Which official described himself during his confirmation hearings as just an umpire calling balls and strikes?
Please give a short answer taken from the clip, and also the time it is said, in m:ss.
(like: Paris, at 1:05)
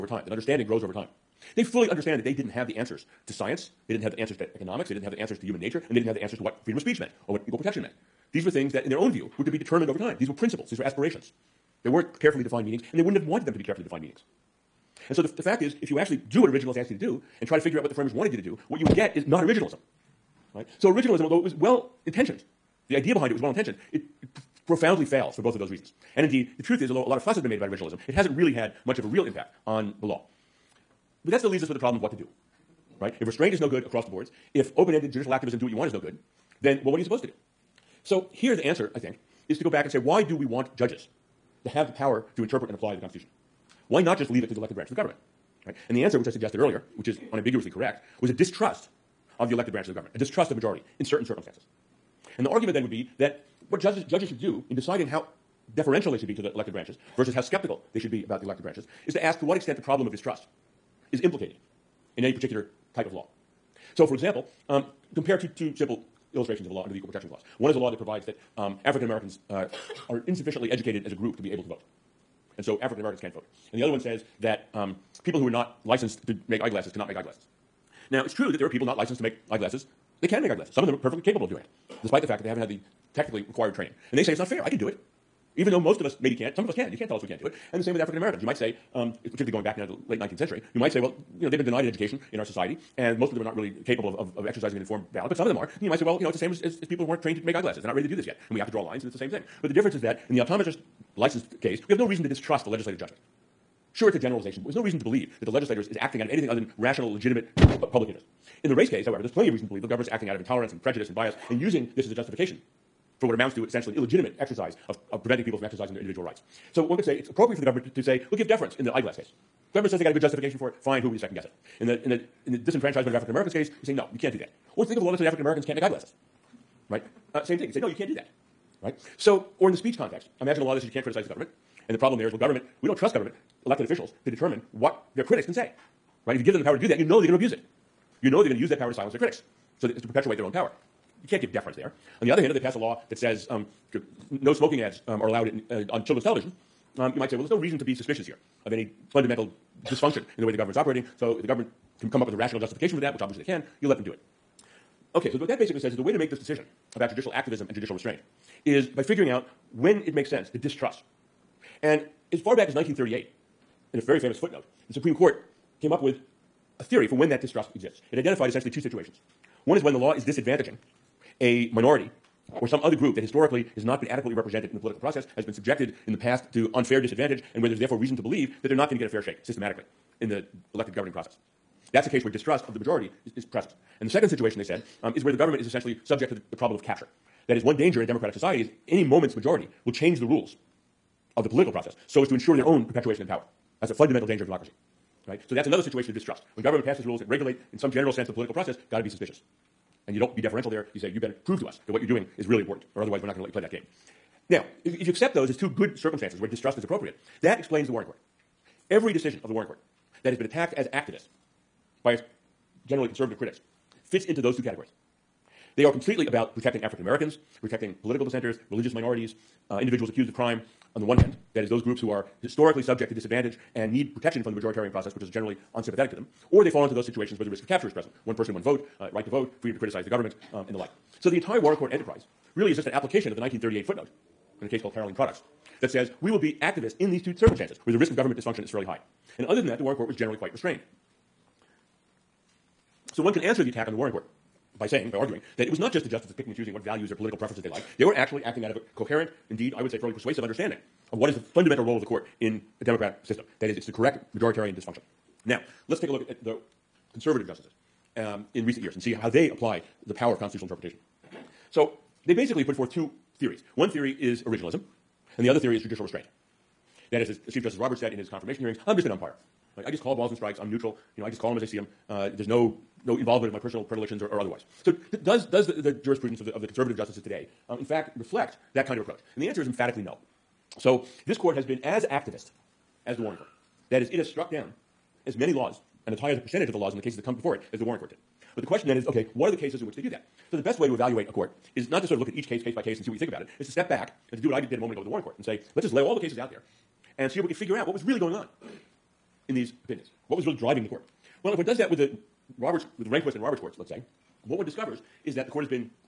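Chief Justice Roberts, at 4:27.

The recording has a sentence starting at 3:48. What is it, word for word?
One person, one vote, uh, right to vote, freedom to criticize the government, um, and the like.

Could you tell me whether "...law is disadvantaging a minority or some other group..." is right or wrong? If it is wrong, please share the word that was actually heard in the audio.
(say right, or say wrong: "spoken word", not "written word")
right.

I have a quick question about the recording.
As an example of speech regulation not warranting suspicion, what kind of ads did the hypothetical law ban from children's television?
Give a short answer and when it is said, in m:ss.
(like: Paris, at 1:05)
Smoking ads, at 2:24.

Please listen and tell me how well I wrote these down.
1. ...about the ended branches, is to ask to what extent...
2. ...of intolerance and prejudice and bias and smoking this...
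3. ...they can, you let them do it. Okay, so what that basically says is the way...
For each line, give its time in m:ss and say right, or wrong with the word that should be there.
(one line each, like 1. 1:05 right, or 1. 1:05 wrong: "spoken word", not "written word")
1. 0:58 wrong: "elected", not "ended"
2. 1:50 wrong: "using", not "smoking"
3. 2:33 right.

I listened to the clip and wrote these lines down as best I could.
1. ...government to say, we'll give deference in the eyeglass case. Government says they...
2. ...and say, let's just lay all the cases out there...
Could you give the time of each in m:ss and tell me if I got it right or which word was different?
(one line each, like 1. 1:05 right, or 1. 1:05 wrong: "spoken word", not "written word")
1. 1:57 right
2. 4:55 right.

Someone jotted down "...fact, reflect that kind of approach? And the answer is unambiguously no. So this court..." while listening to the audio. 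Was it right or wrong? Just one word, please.
wrong.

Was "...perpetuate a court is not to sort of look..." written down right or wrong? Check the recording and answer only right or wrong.
wrong.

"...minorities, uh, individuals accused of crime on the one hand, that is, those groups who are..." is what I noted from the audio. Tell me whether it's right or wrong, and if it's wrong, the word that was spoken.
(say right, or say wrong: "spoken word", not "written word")
right.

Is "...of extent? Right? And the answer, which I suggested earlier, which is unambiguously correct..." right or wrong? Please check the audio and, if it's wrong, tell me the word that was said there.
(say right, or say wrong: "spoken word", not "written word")
wrong: "government", not "extent".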